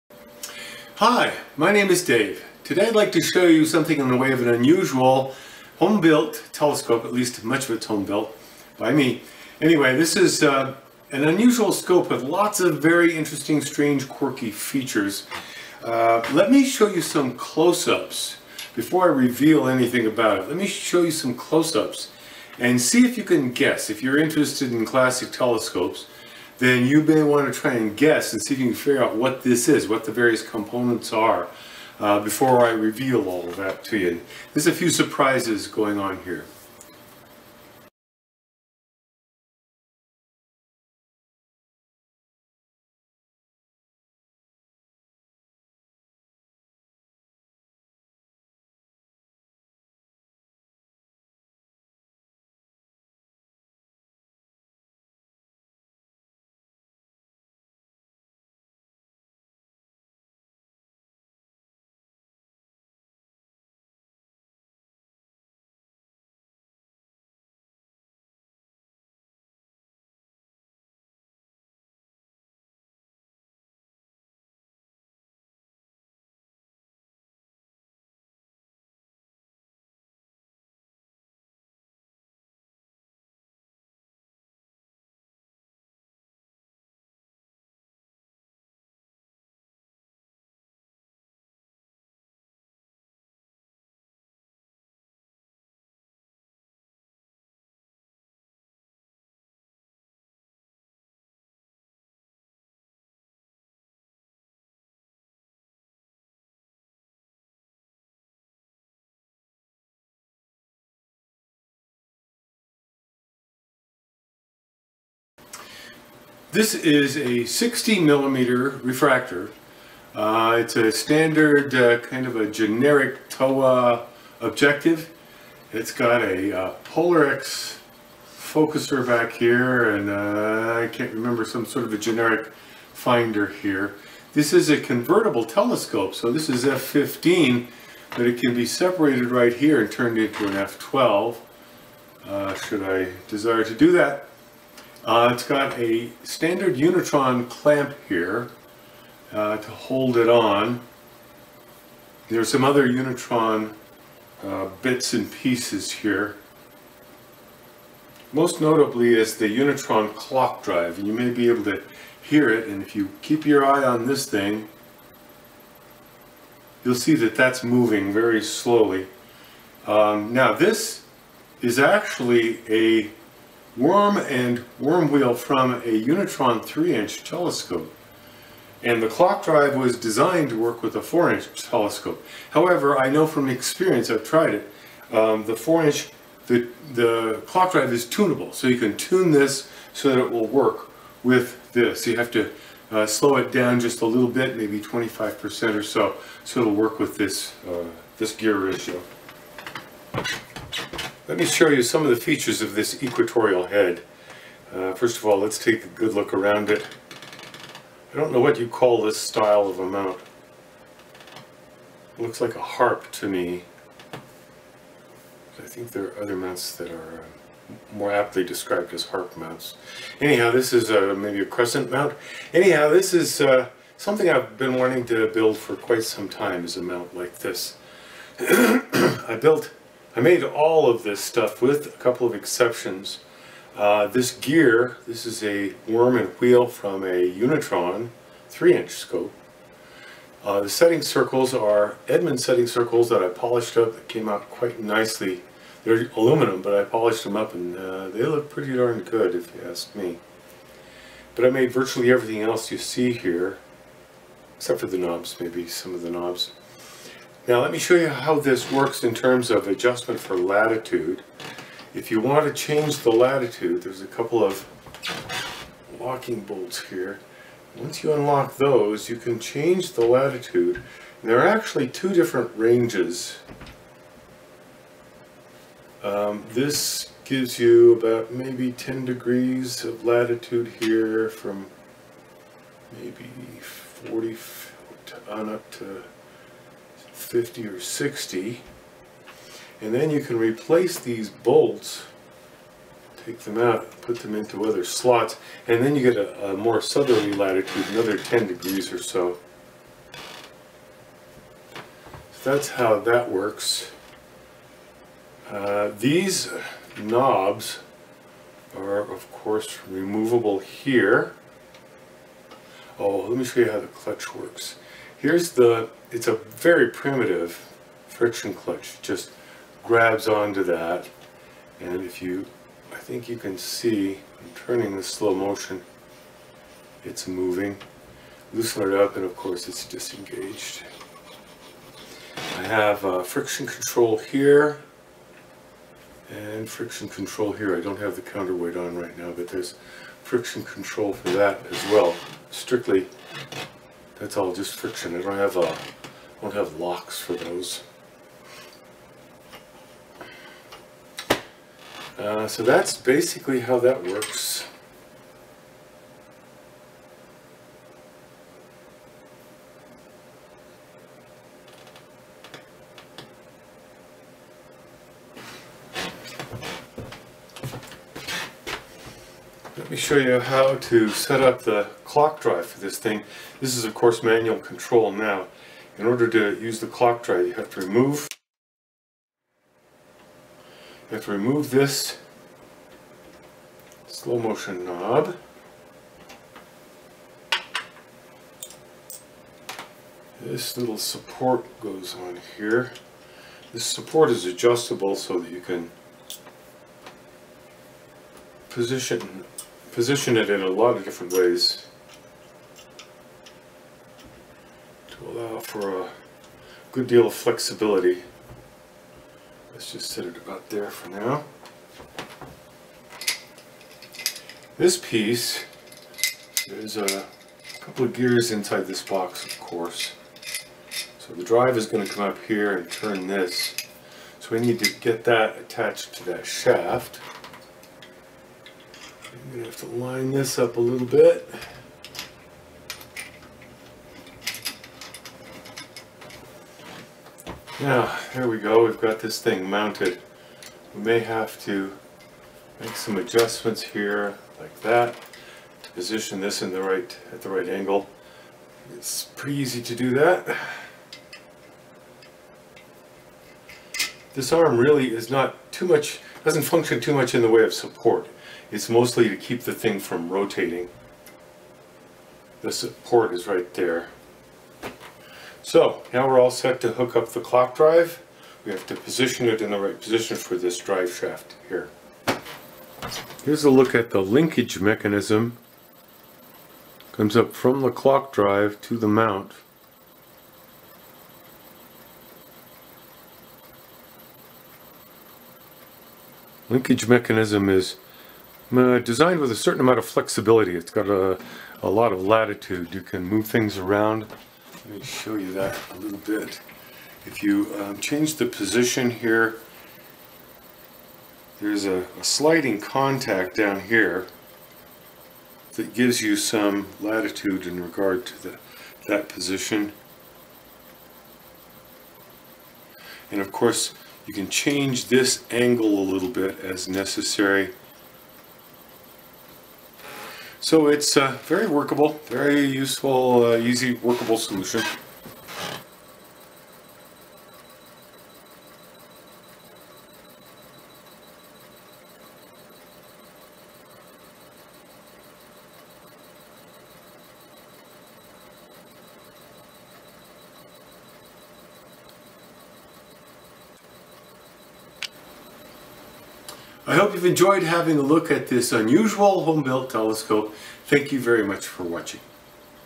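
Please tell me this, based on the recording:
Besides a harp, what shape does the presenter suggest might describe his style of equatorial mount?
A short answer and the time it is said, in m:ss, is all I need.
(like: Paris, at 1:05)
crescent, at 3:41.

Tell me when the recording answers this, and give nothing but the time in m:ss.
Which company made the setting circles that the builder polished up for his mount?
4:02.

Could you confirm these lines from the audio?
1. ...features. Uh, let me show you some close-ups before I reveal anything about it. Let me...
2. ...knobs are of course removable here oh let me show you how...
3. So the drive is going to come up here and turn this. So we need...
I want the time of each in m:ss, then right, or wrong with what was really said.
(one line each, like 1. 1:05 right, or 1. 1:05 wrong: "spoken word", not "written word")
1. 0:14 right
2. 5:07 right
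3. 7:01 right.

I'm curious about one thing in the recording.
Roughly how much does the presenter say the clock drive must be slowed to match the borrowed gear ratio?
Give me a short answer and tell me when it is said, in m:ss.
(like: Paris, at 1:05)
25%, at 3:14.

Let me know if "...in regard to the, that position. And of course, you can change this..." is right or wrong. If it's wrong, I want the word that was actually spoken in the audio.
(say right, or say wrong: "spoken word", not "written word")
right.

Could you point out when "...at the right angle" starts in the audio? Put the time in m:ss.
7:27.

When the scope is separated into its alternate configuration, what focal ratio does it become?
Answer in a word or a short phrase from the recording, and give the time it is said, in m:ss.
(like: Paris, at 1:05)
f12, at 2:20.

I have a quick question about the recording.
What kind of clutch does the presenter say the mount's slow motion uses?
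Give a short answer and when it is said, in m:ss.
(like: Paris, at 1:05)
primitive friction clutch, at 5:16.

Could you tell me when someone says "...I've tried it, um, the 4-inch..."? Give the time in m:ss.
3:04.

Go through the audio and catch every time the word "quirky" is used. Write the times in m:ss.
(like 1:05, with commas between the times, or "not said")
0:14.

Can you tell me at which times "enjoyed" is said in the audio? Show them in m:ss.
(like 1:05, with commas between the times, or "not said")
9:07.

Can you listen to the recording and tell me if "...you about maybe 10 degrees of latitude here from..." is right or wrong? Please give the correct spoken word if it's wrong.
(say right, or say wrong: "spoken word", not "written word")
right.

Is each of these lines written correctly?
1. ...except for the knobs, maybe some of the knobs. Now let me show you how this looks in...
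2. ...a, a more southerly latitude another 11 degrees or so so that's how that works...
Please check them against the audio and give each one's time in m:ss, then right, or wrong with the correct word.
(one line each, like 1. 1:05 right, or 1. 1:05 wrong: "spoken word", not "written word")
1. 4:14 wrong: "works", not "looks"
2. 4:56 wrong: "10", not "11".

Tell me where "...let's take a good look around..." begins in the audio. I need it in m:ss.
3:25.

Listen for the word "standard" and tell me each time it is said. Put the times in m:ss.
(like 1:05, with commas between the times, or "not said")
2:00, 2:26.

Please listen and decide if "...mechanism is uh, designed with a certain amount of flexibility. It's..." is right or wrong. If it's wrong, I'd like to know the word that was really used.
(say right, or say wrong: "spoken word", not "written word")
right.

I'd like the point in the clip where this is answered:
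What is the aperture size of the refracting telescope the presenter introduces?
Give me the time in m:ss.
1:57.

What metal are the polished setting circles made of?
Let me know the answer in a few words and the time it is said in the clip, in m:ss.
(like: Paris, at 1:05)
aluminum, at 4:06.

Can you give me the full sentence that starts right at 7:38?
It's mostly to keep the thing from rotating.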